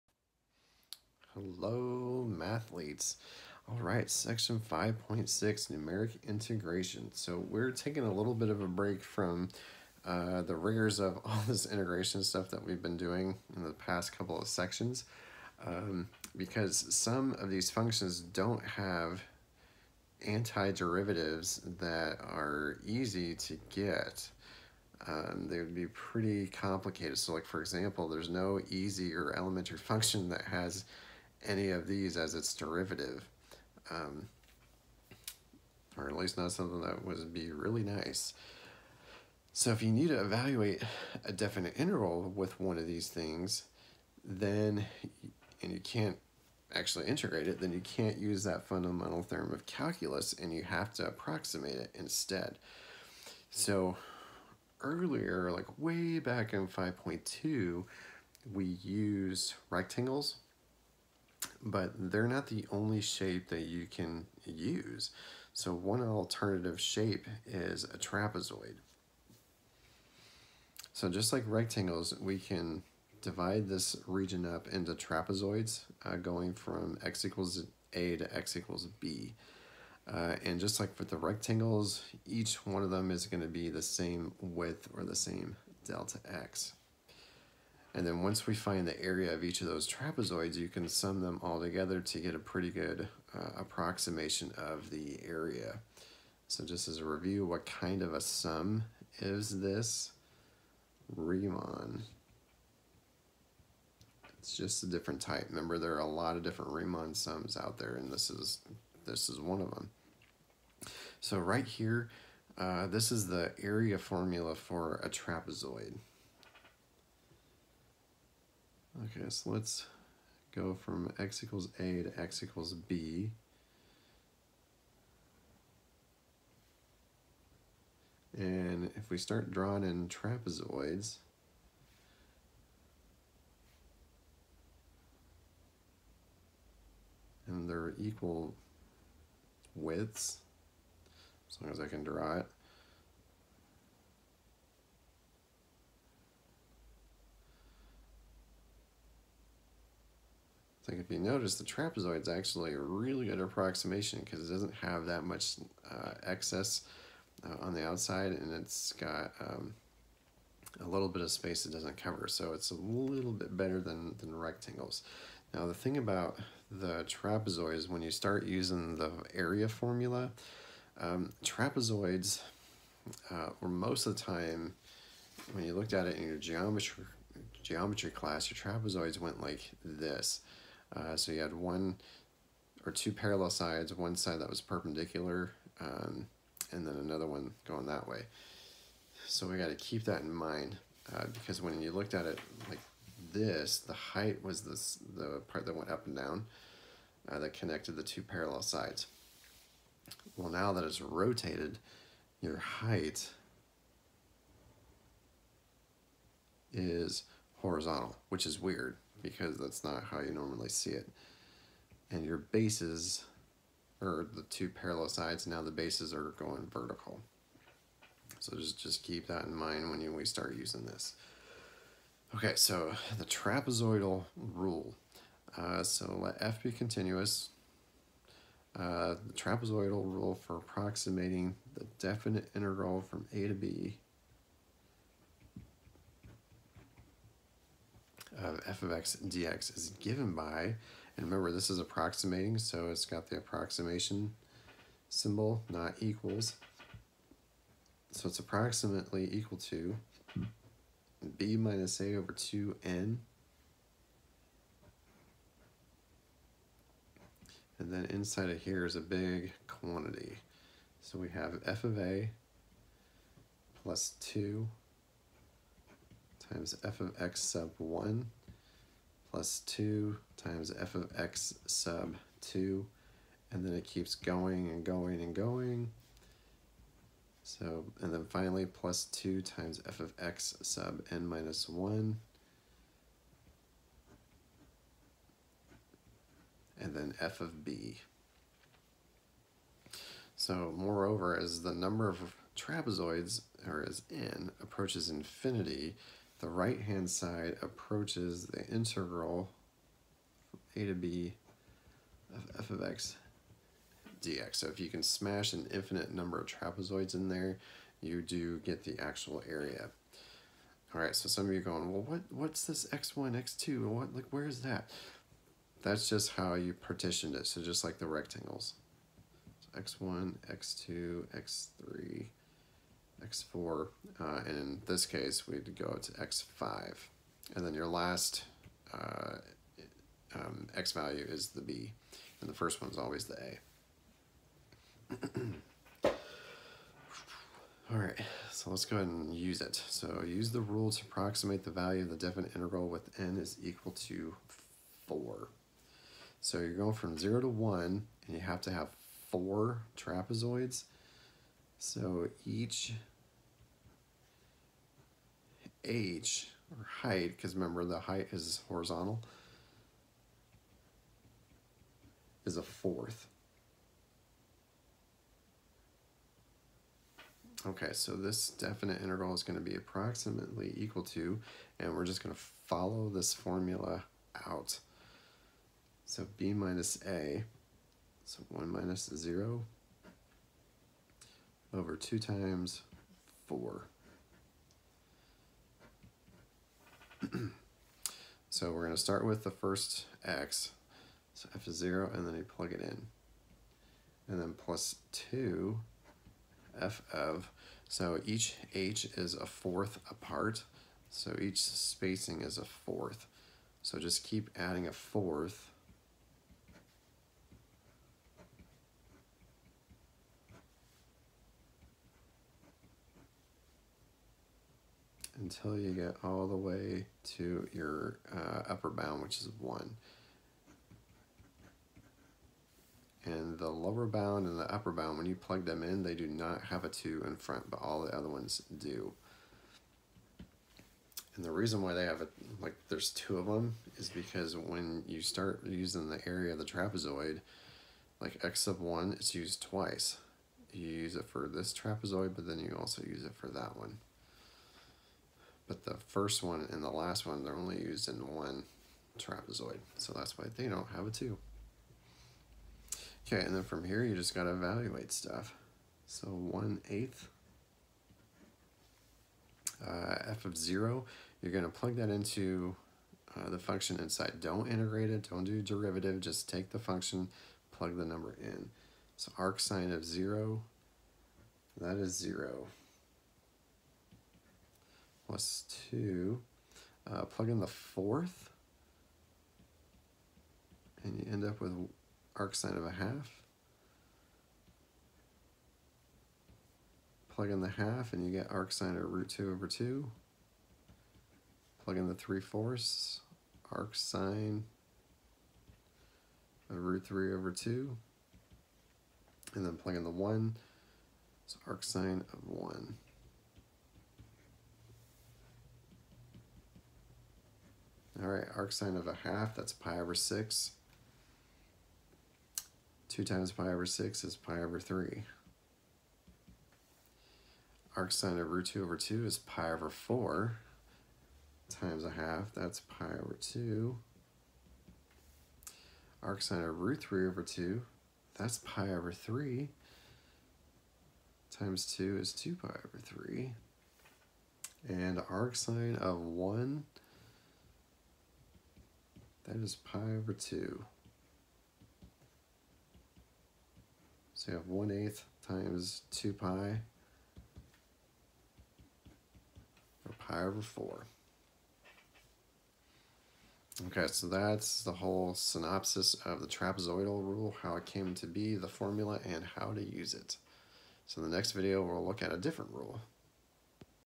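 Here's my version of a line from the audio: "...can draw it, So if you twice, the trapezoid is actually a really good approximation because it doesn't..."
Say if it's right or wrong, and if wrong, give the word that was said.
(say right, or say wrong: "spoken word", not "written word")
wrong: "notice", not "twice".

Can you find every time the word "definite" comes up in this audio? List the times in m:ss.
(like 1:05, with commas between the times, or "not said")
0:41, 3:51, 5:42, 6:08.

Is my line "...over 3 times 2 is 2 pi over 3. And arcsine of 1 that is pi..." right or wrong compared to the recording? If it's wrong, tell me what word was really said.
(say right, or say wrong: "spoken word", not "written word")
right.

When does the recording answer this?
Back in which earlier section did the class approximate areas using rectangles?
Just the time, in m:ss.
0:56.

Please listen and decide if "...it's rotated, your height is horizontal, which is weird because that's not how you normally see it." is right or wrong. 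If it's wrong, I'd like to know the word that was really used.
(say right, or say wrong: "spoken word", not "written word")
right.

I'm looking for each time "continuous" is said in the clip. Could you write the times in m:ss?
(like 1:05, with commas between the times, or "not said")
3:46.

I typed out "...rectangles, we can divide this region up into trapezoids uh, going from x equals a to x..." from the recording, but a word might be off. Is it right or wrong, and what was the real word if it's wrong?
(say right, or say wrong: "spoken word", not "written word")
right.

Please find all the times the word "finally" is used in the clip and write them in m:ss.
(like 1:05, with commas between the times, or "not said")
4:38.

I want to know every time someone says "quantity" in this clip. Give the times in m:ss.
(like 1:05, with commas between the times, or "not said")
4:19.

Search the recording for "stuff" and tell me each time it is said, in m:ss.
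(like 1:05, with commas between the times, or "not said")
0:12, 7:35.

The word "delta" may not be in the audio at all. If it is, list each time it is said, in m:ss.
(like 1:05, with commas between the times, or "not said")
1:25.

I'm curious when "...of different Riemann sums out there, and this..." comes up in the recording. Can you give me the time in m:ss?
1:46.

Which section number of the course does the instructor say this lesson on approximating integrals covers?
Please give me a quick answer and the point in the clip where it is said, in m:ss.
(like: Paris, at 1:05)
5.6, at 0:04.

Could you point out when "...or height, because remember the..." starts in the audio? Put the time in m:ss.
5:56.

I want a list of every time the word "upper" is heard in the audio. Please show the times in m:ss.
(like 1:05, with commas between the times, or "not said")
6:58, 7:04.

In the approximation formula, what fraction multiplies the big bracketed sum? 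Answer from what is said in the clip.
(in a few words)
b minus a over 2n.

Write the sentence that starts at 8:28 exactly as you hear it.
All right, arcsine of a half, that's pi over 6.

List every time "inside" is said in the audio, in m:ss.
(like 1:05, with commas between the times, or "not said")
4:18, 7:44.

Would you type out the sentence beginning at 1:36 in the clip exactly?
So just as a review, what kind of a sum is this Riemann?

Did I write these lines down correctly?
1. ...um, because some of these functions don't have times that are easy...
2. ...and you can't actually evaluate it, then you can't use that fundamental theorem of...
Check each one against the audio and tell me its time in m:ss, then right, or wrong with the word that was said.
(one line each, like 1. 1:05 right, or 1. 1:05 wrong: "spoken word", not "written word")
1. 0:15 wrong: "antiderivatives", not "times"
2. 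0:45 wrong: "integrate", not "evaluate".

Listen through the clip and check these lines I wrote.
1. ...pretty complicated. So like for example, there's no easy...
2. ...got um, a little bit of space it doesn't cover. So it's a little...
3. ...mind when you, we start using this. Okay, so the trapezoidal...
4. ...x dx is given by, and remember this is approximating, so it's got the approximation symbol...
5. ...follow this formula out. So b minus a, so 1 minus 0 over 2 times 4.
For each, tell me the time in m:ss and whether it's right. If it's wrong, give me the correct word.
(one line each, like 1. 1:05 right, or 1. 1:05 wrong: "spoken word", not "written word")
1. 0:25 right
2. 2:38 right
3. 3:39 right
4. 3:58 right
5. 6:12 right.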